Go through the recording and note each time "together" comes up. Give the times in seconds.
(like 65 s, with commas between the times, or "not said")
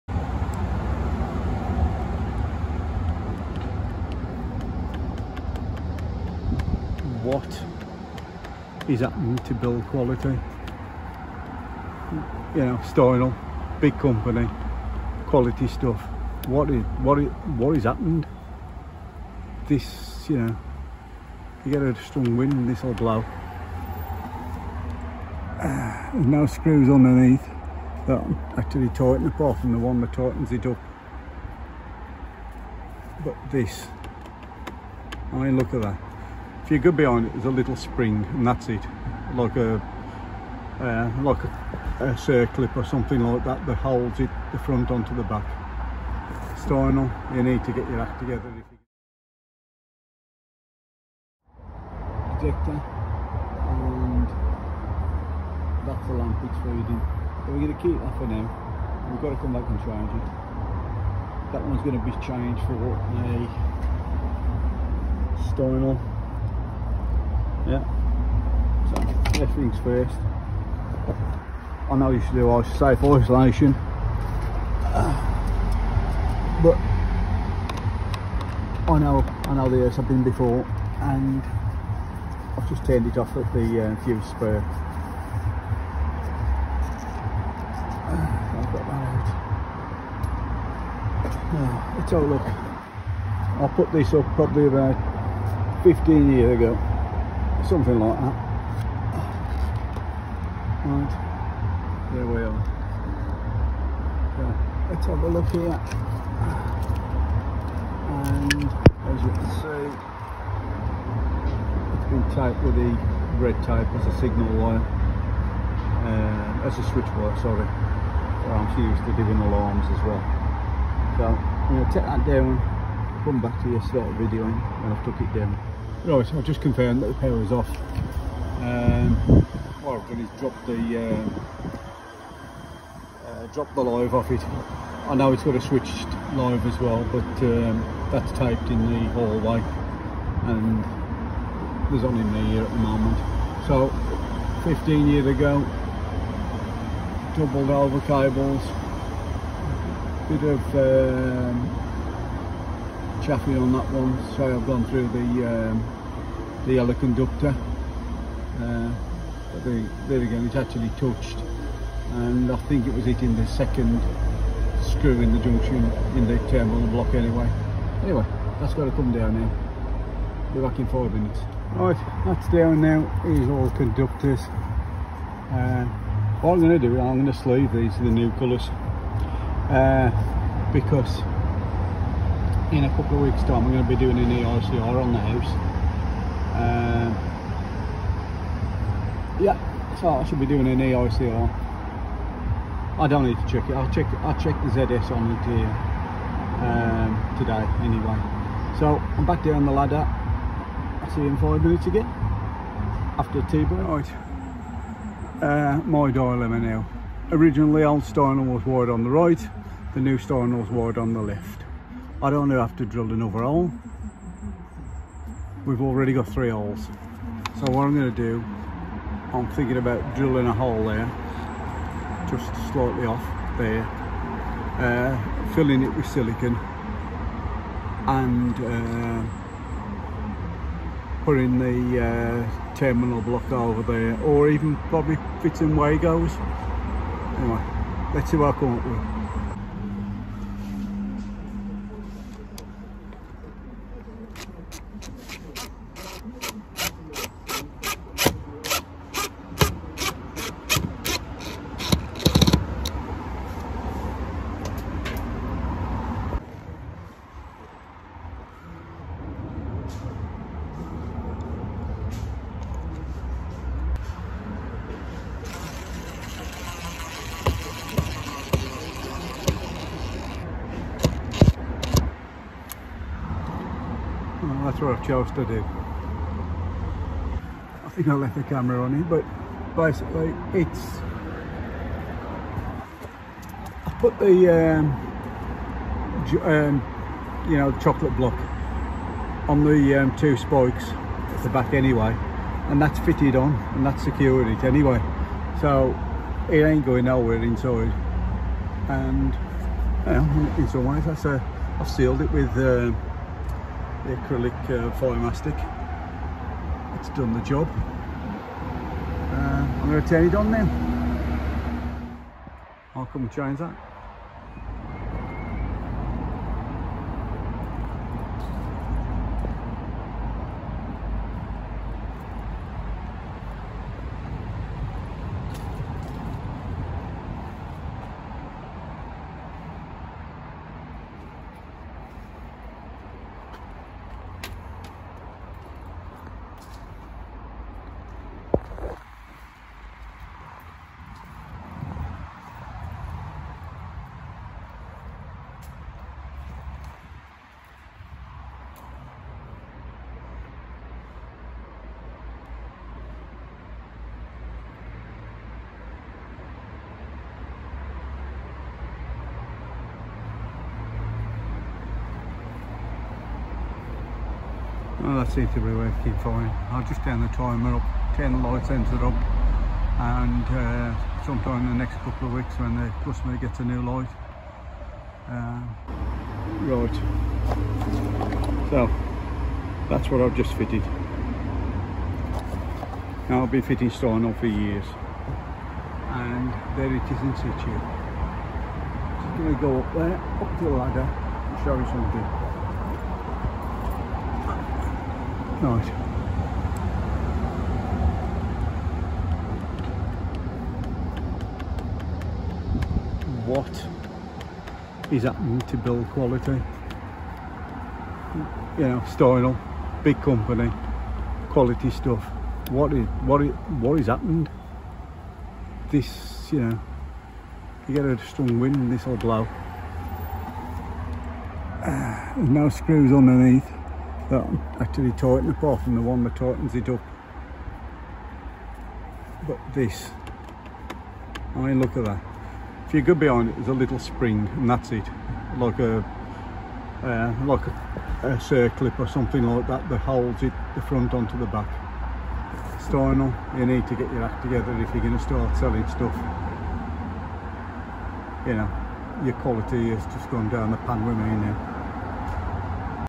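48 s, 444 s.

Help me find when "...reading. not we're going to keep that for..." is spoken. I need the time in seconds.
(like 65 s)
56 s.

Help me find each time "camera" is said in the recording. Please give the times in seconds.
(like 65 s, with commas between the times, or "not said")
278 s.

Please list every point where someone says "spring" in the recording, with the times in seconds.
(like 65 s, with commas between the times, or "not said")
37 s, 433 s.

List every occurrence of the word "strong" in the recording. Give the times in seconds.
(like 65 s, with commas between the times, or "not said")
22 s, 418 s.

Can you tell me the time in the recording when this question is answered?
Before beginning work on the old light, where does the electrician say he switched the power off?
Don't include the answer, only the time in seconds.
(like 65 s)
84 s.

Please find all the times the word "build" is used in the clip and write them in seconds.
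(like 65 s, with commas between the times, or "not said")
9 s, 405 s.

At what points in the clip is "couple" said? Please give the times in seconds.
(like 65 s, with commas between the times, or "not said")
182 s, 371 s.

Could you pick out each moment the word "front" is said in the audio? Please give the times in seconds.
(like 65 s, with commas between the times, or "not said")
44 s, 440 s.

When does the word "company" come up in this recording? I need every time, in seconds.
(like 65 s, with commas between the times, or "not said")
13 s, 410 s.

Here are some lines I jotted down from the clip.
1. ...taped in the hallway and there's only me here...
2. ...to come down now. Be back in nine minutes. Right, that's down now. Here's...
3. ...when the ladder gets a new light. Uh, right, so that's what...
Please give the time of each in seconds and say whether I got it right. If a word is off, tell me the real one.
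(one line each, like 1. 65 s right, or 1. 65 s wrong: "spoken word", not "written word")
1. 138 s right
2. 168 s wrong: "five", not "nine"
3. 372 s wrong: "customer", not "ladder".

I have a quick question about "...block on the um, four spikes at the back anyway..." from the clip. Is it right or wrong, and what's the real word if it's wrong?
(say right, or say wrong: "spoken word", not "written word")
wrong: "two", not "four".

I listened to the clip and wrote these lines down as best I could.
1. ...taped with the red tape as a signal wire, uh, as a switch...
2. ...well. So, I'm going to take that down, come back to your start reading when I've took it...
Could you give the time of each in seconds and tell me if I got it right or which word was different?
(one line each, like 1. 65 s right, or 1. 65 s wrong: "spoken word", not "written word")
1. 112 s right
2. 120 s wrong: "videoing", not "reading".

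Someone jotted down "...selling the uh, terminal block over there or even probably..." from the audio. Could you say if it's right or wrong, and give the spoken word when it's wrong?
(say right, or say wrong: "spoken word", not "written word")
wrong: "putting", not "selling".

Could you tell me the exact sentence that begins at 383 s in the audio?
Now I've been fitting Steinel for years, and there it is in situ.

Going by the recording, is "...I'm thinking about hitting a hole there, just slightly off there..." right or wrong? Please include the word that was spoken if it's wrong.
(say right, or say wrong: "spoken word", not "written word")
wrong: "drilling", not "hitting".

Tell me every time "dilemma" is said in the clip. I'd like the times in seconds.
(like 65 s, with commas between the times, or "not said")
206 s.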